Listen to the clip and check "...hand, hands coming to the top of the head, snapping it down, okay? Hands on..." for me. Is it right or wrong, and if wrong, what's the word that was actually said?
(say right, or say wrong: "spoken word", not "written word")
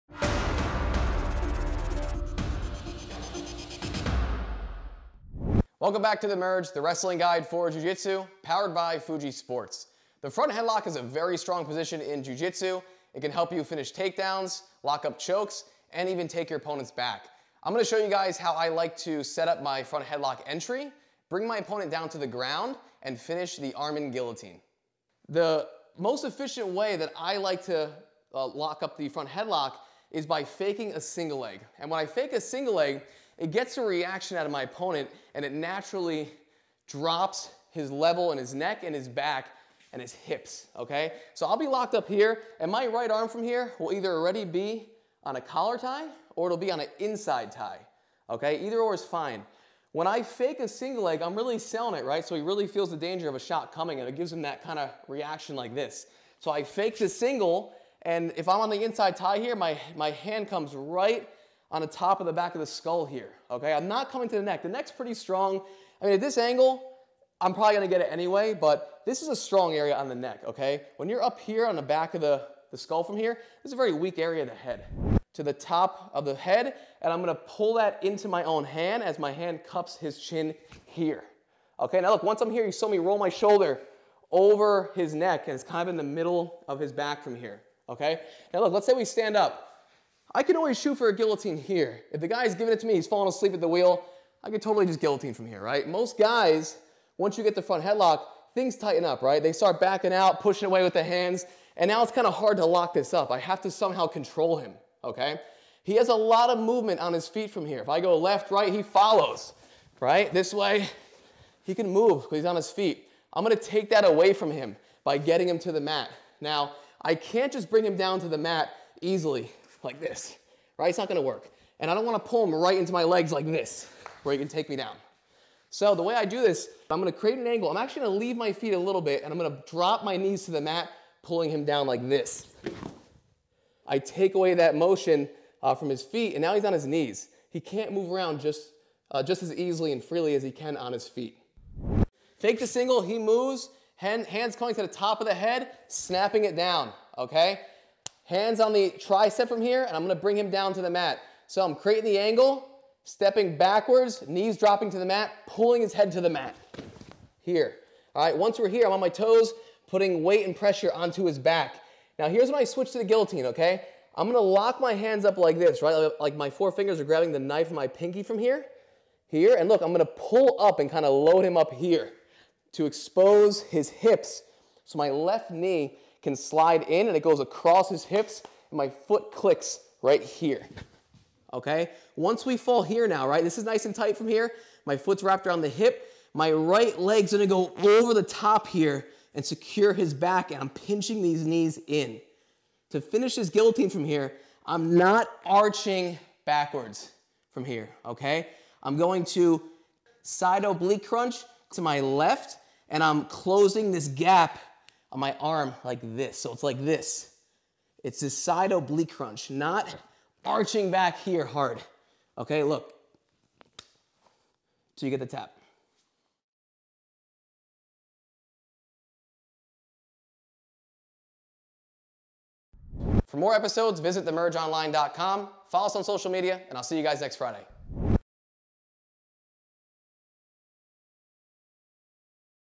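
right.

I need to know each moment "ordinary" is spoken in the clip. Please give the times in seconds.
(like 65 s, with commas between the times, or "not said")
not said.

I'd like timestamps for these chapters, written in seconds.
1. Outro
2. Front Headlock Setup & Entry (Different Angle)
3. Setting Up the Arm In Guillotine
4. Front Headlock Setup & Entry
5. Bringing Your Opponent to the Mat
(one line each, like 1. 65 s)
1. 223 s
2. 142 s
3. 162 s
4. 25 s
5. 105 s.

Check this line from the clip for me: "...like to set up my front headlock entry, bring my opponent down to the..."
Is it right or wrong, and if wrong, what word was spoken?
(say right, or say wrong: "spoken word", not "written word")
right.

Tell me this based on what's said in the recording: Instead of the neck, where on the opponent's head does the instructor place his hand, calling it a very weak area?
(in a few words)
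Back of the skull.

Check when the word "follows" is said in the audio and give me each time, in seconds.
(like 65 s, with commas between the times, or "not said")
108 s, 225 s.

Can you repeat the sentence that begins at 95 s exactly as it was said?
Most guys, once you get the front headlock, things tighten up, right?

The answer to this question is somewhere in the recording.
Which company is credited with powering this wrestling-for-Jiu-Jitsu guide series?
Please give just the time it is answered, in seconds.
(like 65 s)
8 s.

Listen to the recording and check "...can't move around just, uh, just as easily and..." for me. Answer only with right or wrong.
right.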